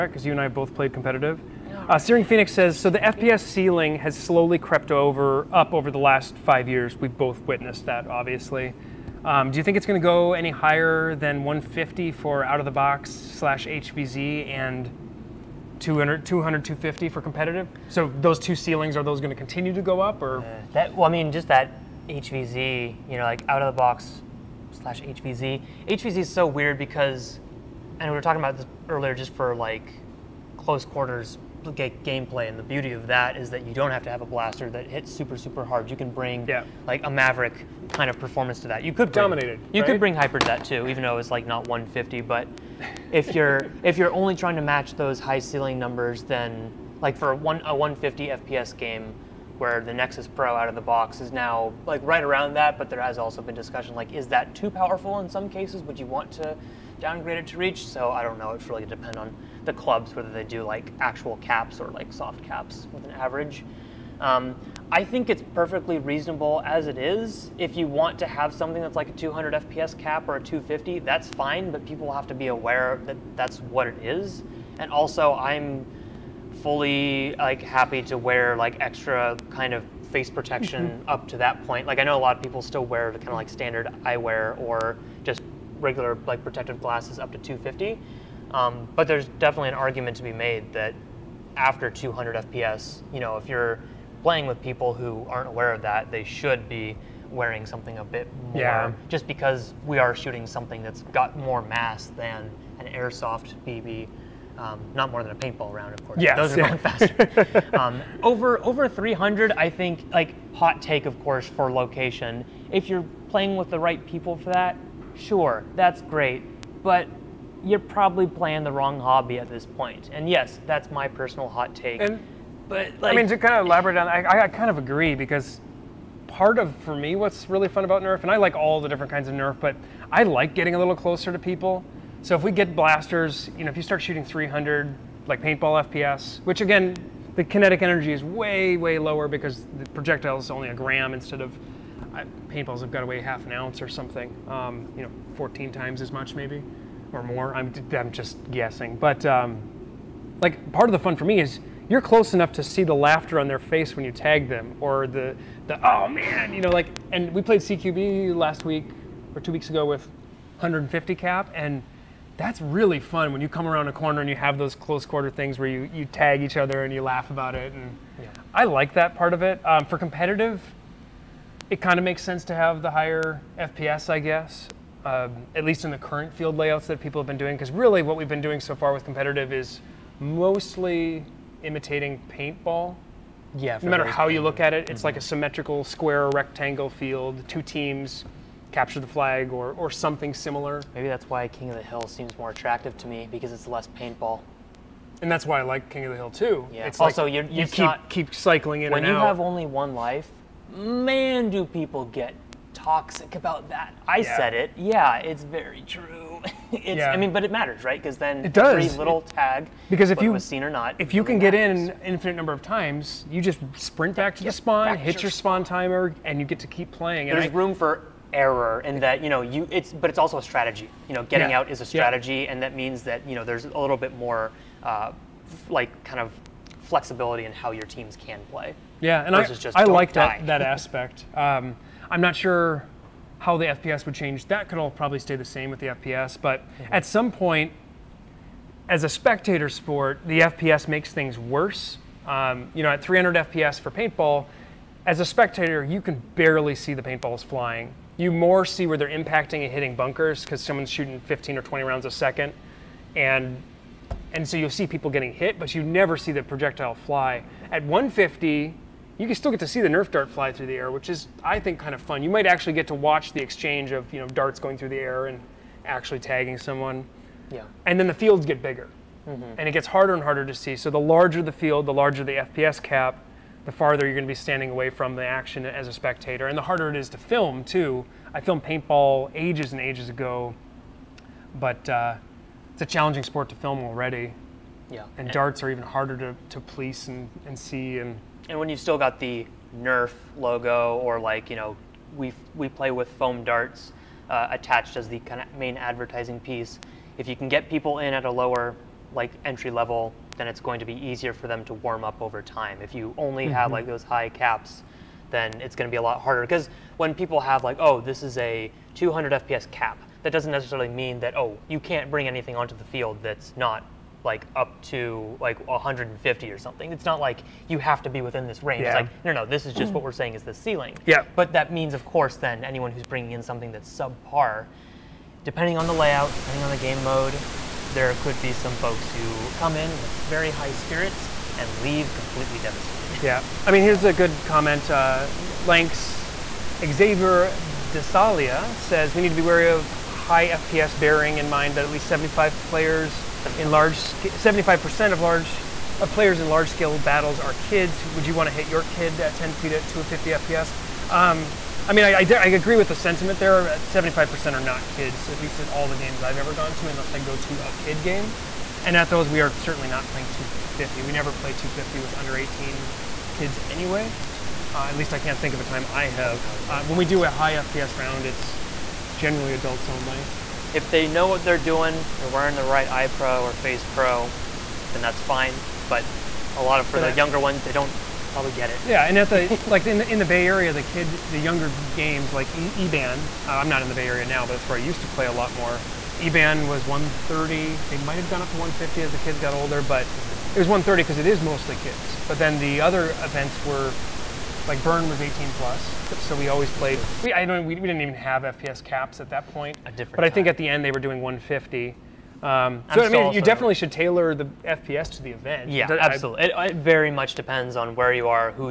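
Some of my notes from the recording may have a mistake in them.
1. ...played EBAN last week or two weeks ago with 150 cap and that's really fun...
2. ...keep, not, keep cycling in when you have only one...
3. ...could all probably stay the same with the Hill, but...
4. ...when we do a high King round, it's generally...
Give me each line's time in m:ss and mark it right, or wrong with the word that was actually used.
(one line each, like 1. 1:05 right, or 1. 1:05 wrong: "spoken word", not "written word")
1. 2:37 wrong: "CQB", not "EBAN"
2. 3:17 right
3. 3:54 wrong: "FPS", not "Hill"
4. 6:06 wrong: "FPS", not "King".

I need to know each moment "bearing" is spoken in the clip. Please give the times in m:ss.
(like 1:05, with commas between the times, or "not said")
5:40.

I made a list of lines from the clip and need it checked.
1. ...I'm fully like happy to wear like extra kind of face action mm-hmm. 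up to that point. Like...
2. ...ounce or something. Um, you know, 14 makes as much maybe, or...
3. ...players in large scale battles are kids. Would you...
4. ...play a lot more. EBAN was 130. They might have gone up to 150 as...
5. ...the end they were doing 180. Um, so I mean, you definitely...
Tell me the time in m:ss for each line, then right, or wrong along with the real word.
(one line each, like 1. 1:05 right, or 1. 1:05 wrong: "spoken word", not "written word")
1. 1:15 wrong: "protection", not "action"
2. 2:23 wrong: "times", not "makes"
3. 5:46 right
4. 6:25 right
5. 6:40 wrong: "150", not "180".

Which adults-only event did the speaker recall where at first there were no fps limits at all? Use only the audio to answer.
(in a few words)
Burn.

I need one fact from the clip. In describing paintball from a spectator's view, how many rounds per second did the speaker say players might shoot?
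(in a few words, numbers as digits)
15 or 20.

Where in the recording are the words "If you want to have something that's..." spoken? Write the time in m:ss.
1:07.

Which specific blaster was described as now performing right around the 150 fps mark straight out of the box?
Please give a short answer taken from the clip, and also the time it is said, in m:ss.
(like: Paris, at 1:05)
Nexus Pro, at 0:49.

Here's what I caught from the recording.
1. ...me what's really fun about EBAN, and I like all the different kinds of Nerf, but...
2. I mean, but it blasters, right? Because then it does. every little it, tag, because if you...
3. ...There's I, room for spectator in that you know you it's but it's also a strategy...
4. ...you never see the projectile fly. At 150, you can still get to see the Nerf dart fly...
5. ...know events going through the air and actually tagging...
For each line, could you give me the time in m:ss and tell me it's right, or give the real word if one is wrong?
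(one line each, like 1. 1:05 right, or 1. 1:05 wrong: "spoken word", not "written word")
1. 2:06 wrong: "Nerf", not "EBAN"
2. 3:27 wrong: "matters", not "blasters"
3. 3:37 wrong: "error", not "spectator"
4. 4:15 right
5. 4:24 wrong: "darts", not "events".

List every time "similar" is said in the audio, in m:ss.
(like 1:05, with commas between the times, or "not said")
3:10.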